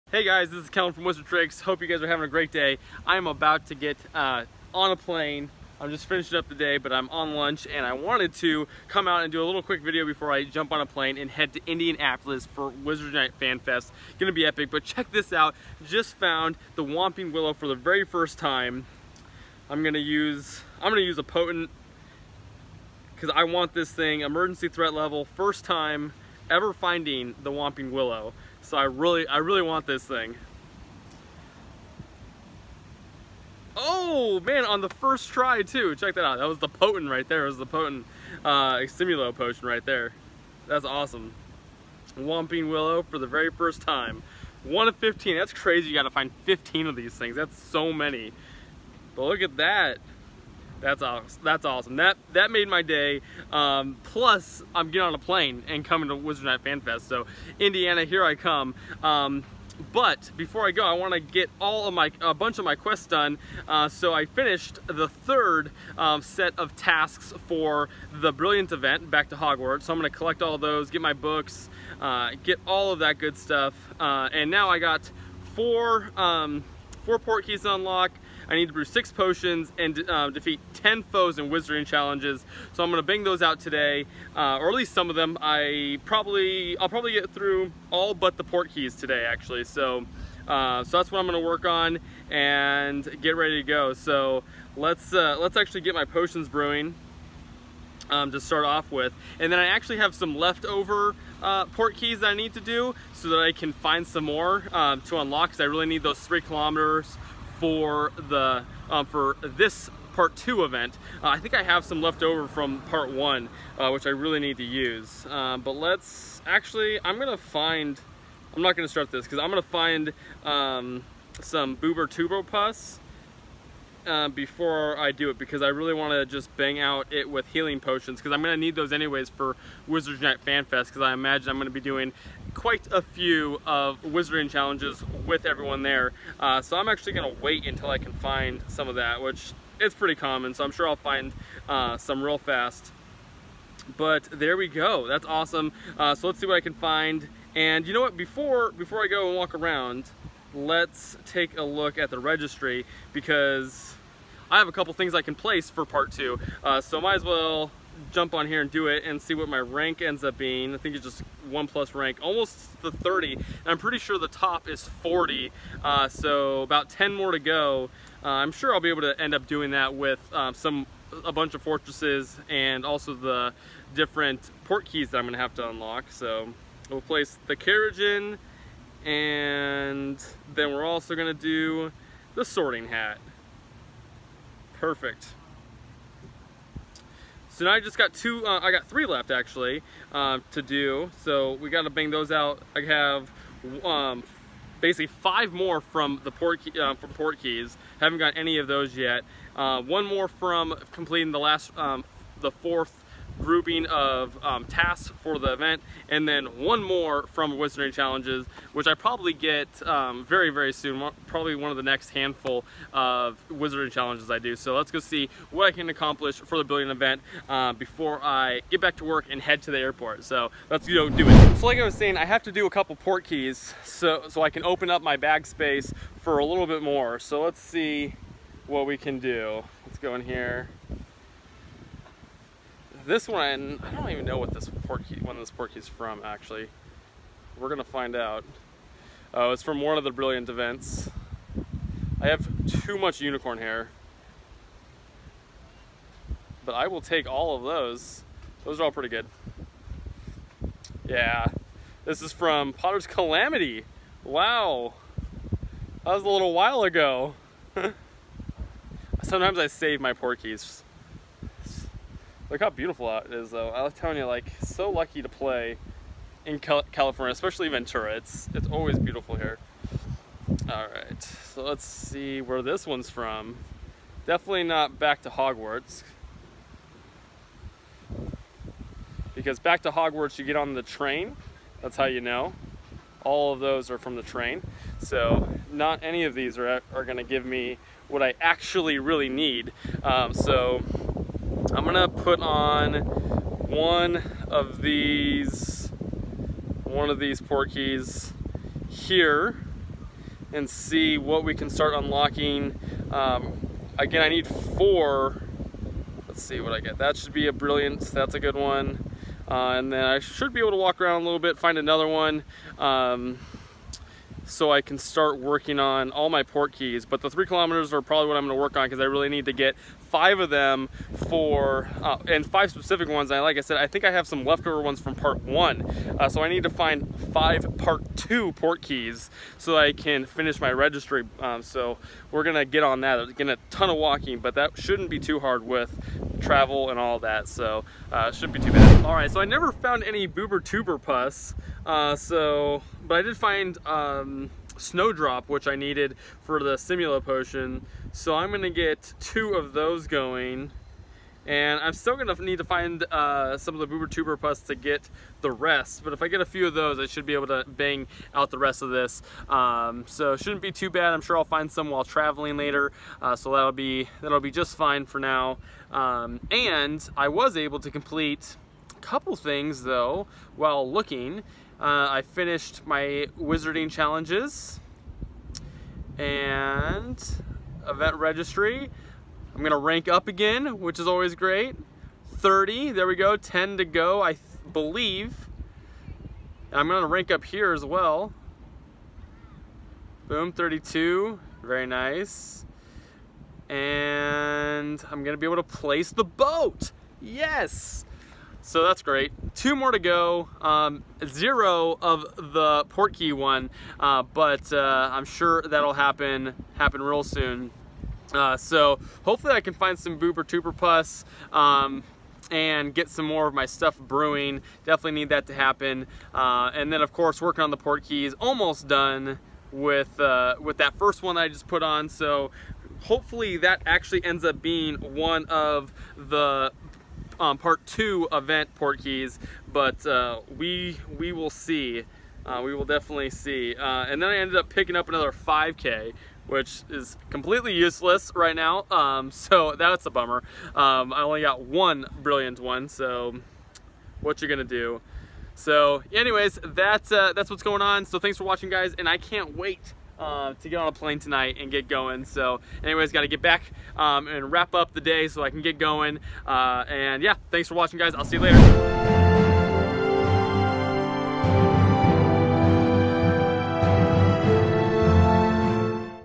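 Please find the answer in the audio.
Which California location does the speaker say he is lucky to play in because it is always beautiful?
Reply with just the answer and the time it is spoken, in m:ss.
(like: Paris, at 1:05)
Ventura, at 4:27.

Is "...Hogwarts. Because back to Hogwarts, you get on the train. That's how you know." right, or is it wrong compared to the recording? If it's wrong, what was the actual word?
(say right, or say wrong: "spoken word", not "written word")
right.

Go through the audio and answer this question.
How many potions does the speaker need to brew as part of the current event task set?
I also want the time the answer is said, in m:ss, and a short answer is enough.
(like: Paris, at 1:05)
6, at 1:18.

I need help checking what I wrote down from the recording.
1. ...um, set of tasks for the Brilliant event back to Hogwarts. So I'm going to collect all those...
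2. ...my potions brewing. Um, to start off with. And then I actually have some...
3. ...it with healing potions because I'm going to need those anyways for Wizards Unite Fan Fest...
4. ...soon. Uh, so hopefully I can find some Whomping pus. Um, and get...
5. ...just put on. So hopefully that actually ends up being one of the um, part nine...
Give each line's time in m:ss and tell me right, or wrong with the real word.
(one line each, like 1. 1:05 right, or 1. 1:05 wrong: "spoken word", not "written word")
1. 1:05 right
2. 1:35 right
3. 2:07 right
4. 6:47 wrong: "Bubotuber", not "Whomping"
5. 7:01 wrong: "two", not "nine".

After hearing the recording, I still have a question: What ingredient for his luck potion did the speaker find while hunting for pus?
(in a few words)
Snowdrop.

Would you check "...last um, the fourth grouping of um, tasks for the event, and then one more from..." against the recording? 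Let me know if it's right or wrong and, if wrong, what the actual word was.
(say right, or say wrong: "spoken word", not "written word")
right.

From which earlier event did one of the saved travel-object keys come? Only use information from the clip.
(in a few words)
Potter's Calamity.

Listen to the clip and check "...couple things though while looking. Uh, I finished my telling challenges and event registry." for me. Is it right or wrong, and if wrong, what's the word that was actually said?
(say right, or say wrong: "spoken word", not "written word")
wrong: "wizarding", not "telling".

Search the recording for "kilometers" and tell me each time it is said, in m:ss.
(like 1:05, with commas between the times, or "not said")
1:46, 5:17.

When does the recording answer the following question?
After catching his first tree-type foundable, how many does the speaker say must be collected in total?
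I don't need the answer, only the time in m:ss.
0:44.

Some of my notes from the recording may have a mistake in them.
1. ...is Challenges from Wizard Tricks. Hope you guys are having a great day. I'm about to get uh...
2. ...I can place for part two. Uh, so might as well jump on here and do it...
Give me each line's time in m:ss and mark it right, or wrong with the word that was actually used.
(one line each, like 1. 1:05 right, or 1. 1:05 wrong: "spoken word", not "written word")
1. 0:00 wrong: "Kellen", not "Challenges"
2. 2:35 right.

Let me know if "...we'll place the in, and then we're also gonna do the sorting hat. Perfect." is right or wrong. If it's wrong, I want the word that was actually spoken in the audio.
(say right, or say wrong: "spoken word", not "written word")
right.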